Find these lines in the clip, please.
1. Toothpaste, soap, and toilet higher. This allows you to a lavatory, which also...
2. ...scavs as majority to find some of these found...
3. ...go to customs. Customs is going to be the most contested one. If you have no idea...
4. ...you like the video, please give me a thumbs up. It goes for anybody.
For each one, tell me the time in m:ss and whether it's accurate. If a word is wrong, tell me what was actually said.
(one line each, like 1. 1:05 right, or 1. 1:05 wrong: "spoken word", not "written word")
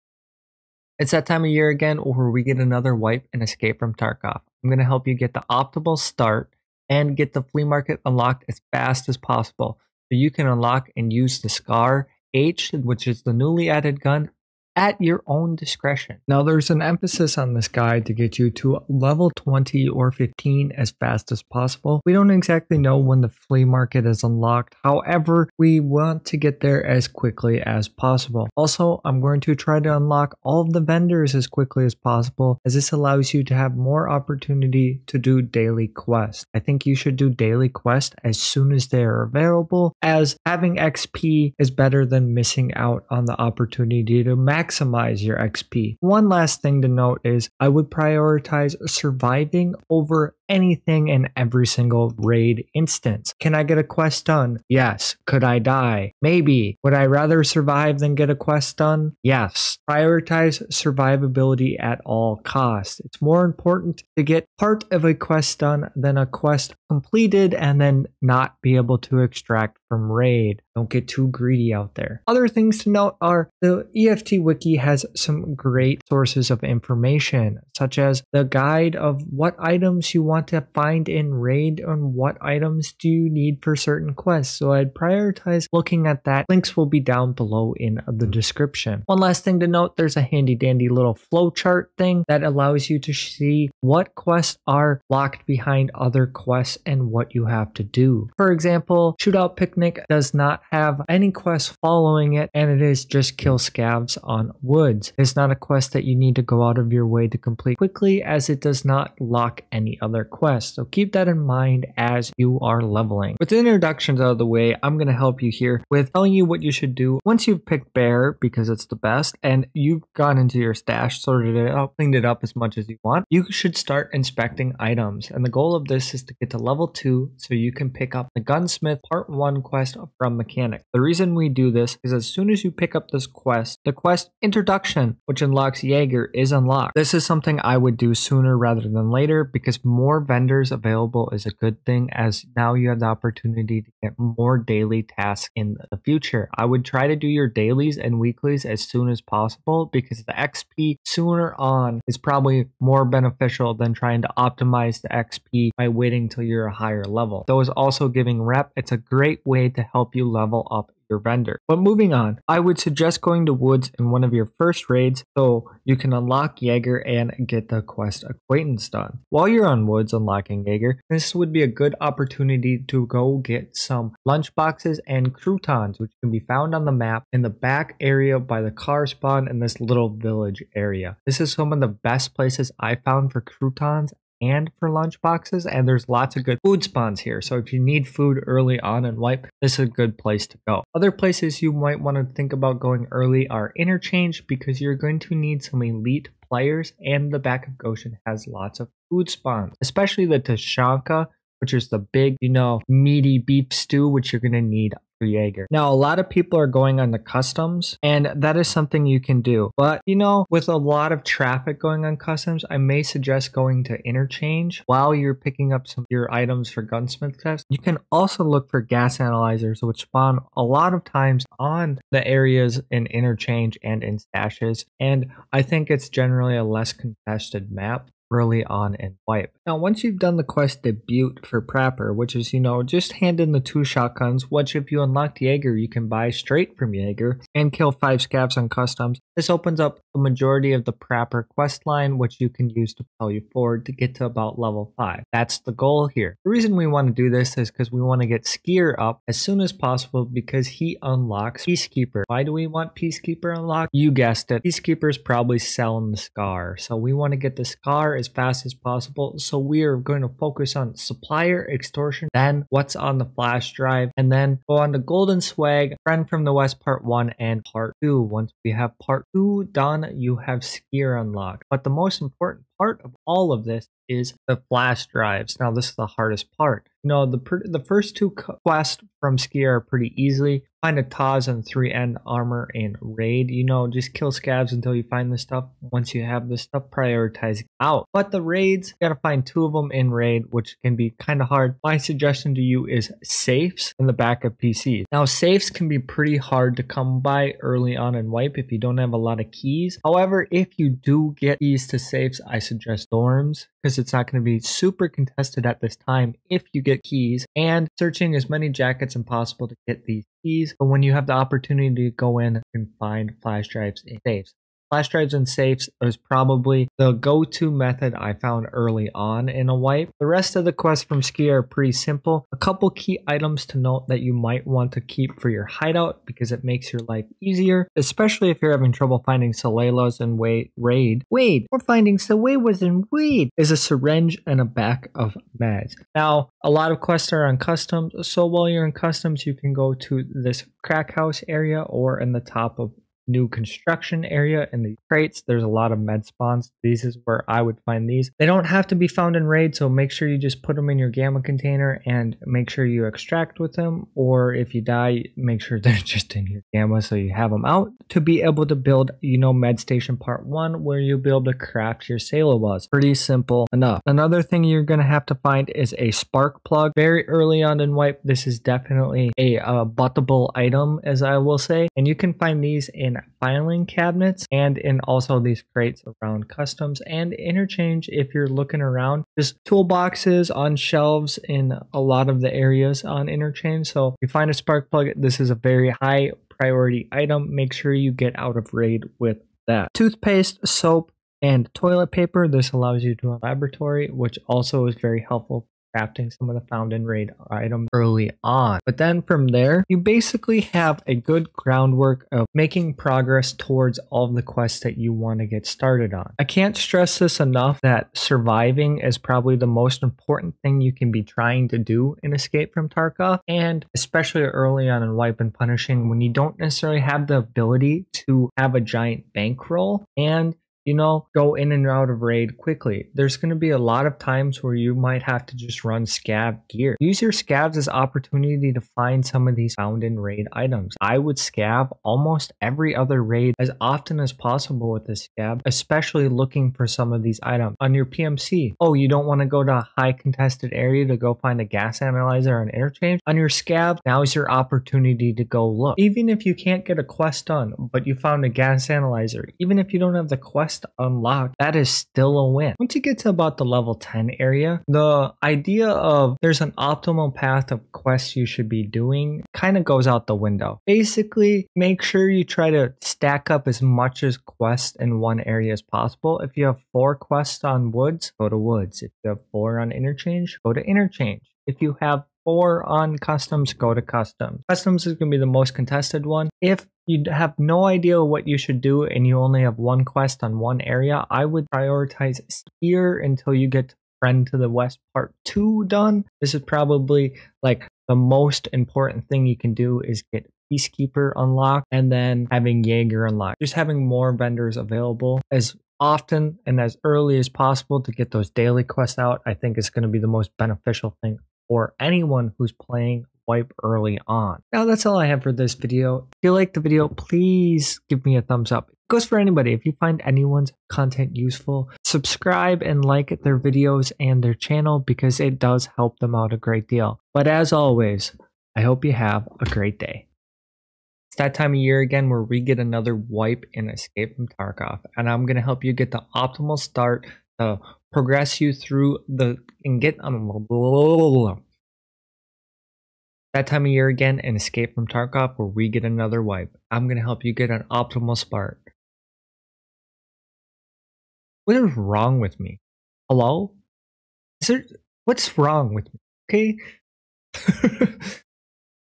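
1. 6:29 wrong: "paper", not "higher"
2. 7:07 wrong: "opportunity", not "majority"
3. 7:53 right
4. 8:26 right.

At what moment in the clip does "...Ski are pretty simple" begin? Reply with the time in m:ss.
5:21.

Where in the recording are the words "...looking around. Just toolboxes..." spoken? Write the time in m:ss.
6:18.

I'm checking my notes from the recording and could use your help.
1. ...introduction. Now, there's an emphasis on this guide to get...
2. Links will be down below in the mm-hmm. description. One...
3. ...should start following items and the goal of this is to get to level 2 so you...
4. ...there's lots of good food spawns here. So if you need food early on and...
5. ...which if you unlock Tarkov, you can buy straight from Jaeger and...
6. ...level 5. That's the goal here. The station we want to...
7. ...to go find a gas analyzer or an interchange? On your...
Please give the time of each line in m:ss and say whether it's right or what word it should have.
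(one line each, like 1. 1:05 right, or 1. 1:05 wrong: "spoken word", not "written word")
1. 0:15 wrong: "discretion", not "introduction"
2. 1:26 right
3. 2:03 wrong: "inspecting", not "following"
4. 3:05 right
5. 3:54 wrong: "Jaeger", not "Tarkov"
6. 4:04 wrong: "reason", not "station"
7. 7:21 right.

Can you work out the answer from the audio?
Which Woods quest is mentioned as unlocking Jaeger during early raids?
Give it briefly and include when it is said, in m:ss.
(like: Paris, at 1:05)
Acquaintance, at 2:48.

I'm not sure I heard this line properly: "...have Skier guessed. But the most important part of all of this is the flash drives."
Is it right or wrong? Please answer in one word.
wrong.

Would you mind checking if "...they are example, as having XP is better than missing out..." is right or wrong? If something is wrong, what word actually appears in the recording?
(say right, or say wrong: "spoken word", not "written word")
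wrong: "available", not "example".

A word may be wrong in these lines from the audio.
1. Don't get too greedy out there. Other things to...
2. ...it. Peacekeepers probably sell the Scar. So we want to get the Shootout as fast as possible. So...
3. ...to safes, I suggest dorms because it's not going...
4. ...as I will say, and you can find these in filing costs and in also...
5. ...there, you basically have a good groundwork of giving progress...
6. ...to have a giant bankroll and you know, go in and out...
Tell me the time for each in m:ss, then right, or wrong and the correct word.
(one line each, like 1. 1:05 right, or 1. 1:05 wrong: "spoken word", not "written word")
1. 1:10 right
2. 4:14 wrong: "Scar", not "Shootout"
3. 5:01 right
4. 6:11 wrong: "cabinets", not "costs"
5. 6:39 wrong: "making", not "giving"
6. 6:58 right.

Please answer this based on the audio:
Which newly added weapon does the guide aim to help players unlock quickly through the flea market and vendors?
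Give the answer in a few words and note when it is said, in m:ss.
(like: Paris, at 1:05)
SCAR H, at 0:11.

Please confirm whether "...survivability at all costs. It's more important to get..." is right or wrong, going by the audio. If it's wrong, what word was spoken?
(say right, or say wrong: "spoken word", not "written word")
right.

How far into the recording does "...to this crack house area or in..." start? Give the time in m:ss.
5:39.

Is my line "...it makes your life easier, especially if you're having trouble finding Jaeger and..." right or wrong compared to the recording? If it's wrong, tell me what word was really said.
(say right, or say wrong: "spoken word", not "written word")
wrong: "Salewas", not "Jaeger".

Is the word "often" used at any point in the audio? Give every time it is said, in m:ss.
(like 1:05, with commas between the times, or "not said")
7:13, 8:15.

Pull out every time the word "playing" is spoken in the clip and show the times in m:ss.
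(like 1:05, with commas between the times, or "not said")
8:22.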